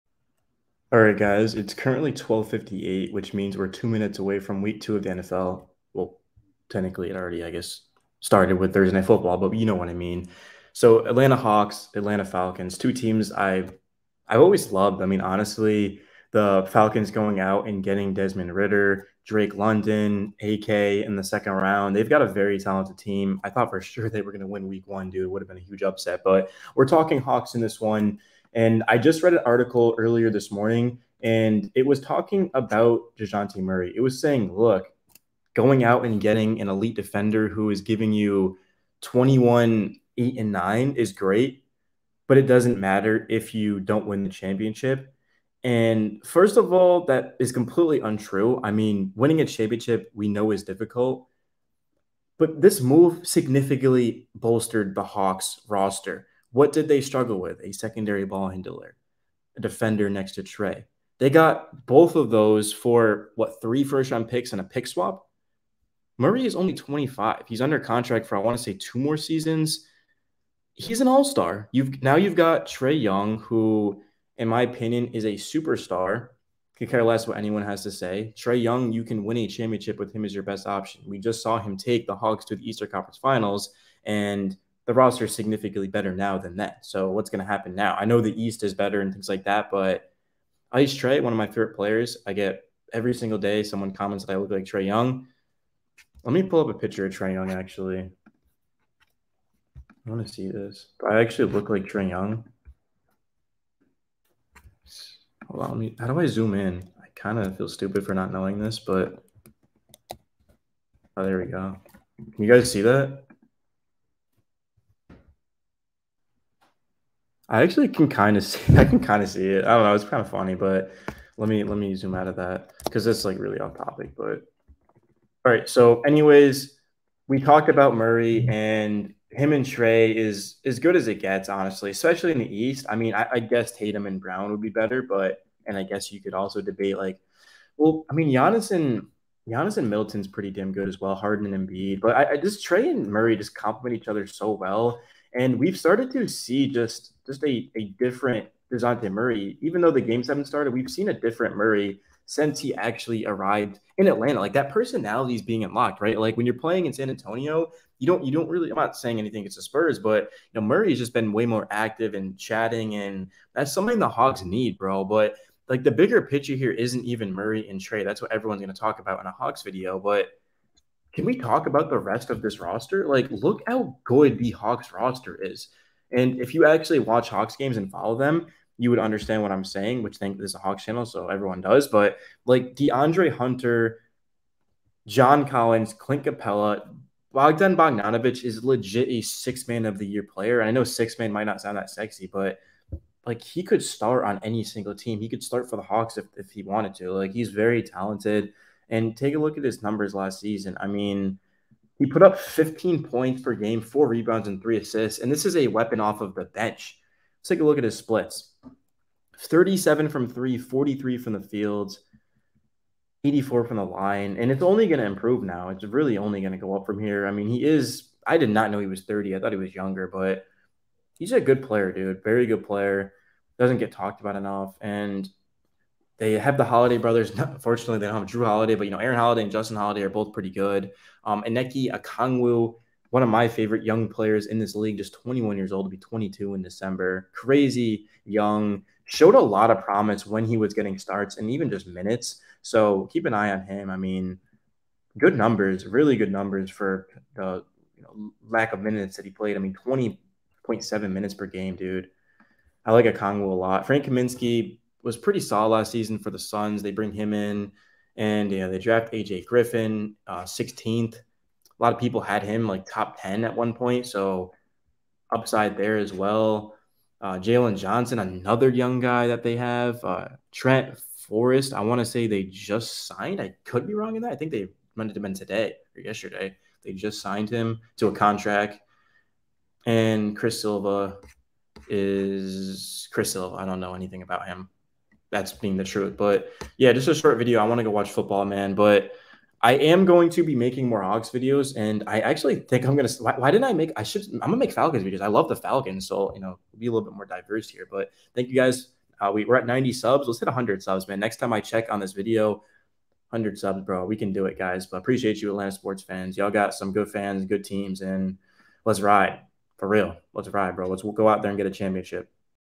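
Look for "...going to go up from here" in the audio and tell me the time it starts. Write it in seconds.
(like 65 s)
216 s.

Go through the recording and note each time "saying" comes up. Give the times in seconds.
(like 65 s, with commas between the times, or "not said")
34 s, 158 s, 179 s.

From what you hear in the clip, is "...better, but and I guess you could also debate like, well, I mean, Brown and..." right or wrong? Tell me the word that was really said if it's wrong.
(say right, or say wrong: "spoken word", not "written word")
wrong: "Giannis", not "Brown".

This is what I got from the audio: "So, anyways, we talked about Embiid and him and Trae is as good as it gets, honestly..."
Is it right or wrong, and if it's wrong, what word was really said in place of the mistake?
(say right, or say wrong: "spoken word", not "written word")
wrong: "Murray", not "Embiid".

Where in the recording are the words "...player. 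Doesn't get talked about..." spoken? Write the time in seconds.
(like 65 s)
222 s.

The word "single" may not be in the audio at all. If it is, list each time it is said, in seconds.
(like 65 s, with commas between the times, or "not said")
93 s, 194 s.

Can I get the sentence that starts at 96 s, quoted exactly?
Let me pull up a picture of Trae Young actually.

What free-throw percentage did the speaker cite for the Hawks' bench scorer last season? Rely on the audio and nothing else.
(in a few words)
84.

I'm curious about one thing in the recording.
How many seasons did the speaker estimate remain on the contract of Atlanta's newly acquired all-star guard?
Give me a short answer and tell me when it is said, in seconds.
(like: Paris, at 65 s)
2, at 68 s.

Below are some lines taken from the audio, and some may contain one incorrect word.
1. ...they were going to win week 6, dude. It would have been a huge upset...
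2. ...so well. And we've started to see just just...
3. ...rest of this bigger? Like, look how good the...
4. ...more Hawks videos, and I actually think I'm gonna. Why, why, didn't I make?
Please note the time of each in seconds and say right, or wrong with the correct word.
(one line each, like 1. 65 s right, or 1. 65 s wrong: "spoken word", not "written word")
1. 24 s wrong: "1", not "6"
2. 144 s right
3. 171 s wrong: "roster", not "bigger"
4. 290 s right.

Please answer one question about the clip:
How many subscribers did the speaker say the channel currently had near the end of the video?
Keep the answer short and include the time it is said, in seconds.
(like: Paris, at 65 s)
90, at 299 s.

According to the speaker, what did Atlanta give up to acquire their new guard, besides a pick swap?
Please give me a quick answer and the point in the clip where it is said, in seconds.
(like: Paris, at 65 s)
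3 first round picks, at 63 s.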